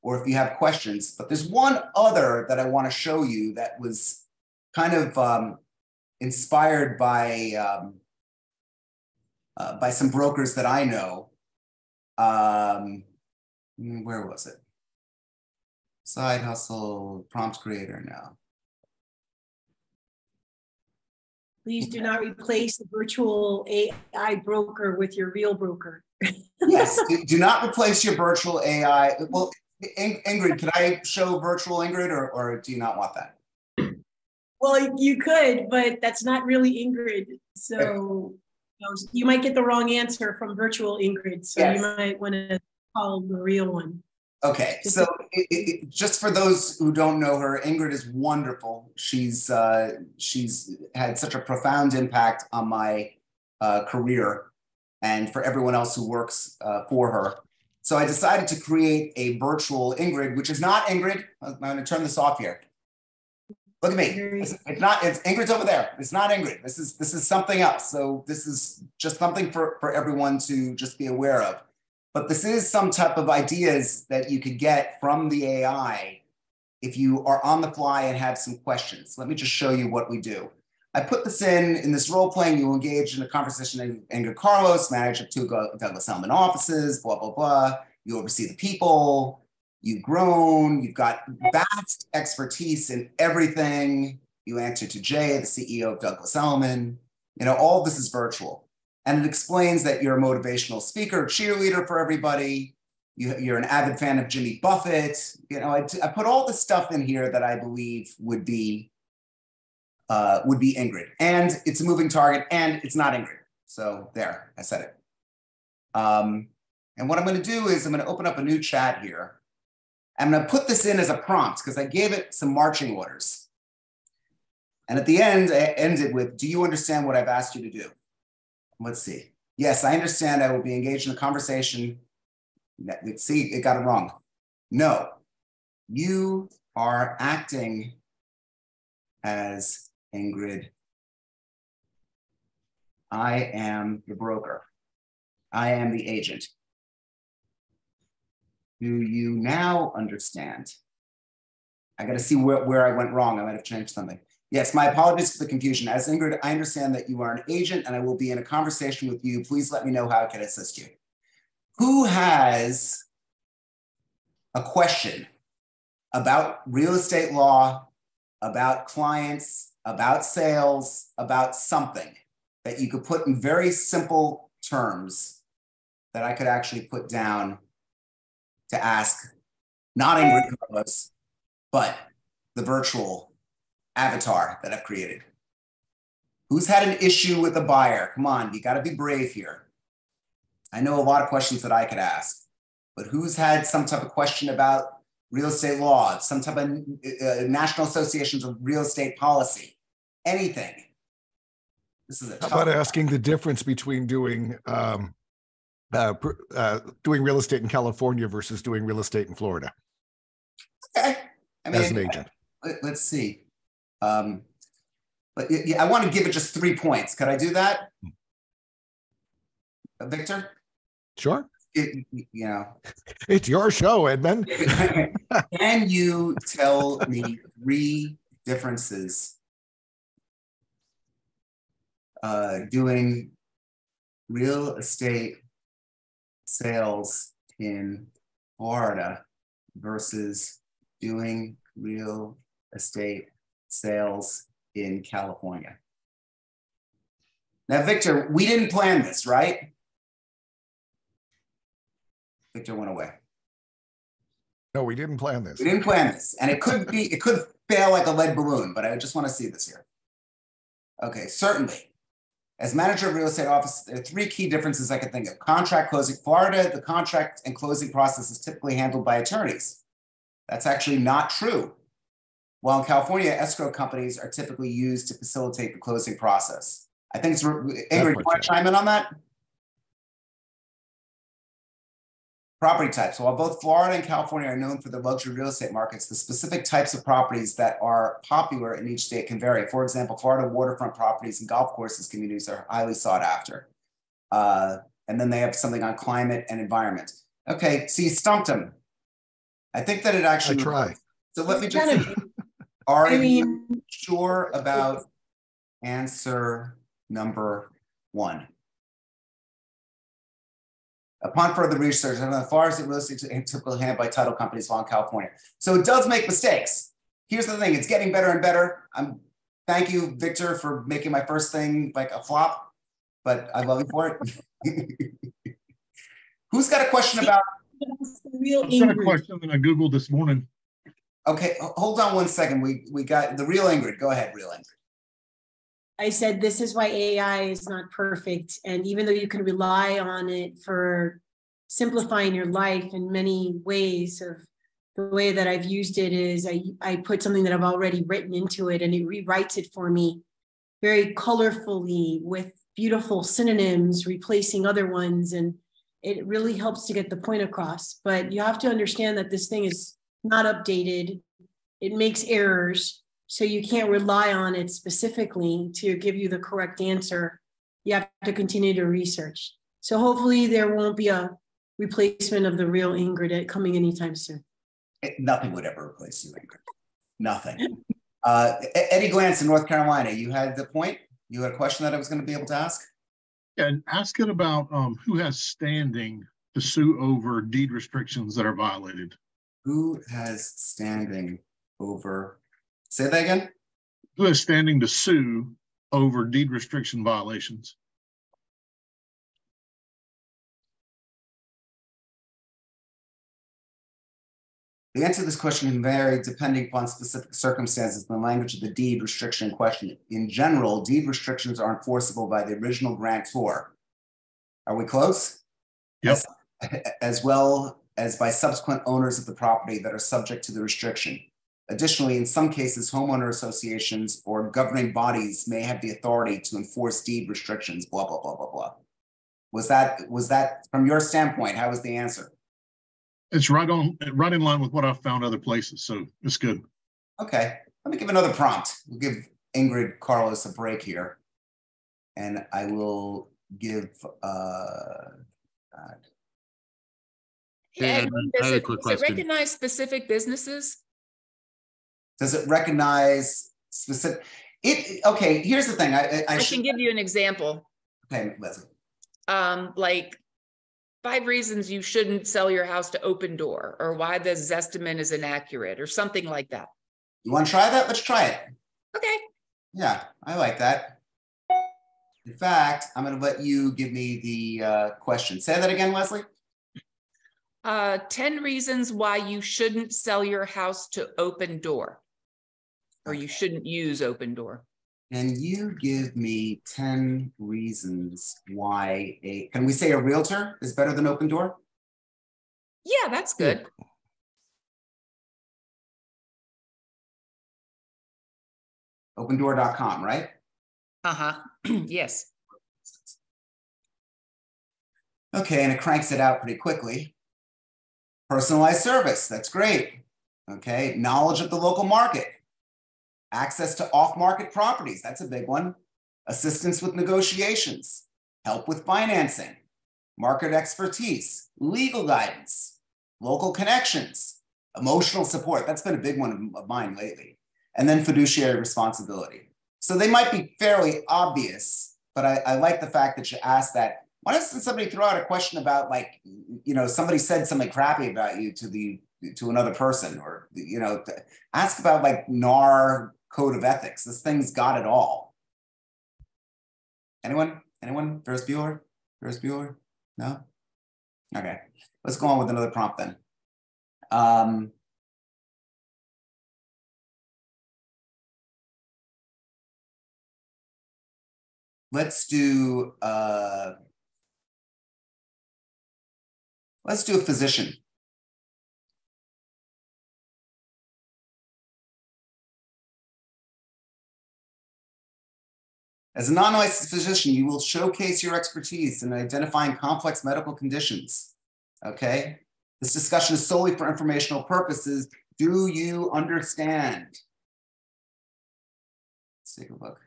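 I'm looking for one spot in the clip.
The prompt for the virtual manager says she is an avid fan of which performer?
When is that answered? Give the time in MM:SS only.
01:44.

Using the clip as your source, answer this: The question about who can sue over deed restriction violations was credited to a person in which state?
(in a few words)
North Carolina.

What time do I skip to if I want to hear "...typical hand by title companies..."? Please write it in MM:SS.
05:13.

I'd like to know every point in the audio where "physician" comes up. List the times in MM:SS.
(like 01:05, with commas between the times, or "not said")
09:27, 09:36.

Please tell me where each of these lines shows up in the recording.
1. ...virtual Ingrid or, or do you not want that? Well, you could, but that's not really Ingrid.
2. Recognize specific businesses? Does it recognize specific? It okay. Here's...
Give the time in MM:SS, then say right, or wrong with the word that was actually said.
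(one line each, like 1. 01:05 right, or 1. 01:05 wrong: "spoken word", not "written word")
1. 00:31 right
2. 07:29 right.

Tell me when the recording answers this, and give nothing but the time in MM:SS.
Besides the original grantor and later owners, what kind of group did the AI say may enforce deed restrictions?
07:02.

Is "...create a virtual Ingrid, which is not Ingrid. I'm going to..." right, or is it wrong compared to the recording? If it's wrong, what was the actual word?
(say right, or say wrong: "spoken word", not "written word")
right.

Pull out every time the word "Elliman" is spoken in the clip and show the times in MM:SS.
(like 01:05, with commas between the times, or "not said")
01:26, 01:36.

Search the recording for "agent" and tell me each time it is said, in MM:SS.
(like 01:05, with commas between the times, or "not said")
02:26, 02:37, 03:31.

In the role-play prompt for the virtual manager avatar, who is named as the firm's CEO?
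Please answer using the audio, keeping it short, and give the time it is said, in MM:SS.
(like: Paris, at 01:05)
Jay, at 01:34.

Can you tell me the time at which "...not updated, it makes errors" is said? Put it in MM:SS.
06:00.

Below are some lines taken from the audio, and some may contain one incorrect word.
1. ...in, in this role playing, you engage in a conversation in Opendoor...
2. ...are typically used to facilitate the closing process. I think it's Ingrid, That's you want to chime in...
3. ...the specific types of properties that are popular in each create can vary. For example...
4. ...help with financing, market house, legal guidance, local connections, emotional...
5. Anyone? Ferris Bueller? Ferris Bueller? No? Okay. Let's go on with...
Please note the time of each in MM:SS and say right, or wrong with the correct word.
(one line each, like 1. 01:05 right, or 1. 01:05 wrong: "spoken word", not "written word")
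1. 01:21 wrong: "Carlos", not "Opendoor"
2. 04:34 right
3. 04:46 wrong: "state", not "create"
4. 08:38 wrong: "expertise", not "house"
5. 09:07 right.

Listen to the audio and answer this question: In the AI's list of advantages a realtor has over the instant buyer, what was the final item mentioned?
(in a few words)
fiduciary responsibility.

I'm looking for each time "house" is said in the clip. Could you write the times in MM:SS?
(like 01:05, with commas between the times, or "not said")
07:42, 08:00.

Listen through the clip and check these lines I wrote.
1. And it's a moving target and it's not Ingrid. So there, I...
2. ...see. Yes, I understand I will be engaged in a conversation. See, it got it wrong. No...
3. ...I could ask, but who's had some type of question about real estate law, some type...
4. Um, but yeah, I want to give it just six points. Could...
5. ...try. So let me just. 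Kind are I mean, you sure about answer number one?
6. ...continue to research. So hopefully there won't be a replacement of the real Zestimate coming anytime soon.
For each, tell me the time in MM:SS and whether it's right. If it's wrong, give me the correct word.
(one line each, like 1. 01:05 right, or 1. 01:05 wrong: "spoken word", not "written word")
1. 01:51 right
2. 02:09 right
3. 03:11 right
4. 03:34 wrong: "three", not "six"
5. 05:00 right
6. 06:08 wrong: "Ingrid", not "Zestimate".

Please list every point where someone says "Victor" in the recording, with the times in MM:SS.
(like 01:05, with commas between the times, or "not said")
03:40, 04:07, 04:12, 05:20.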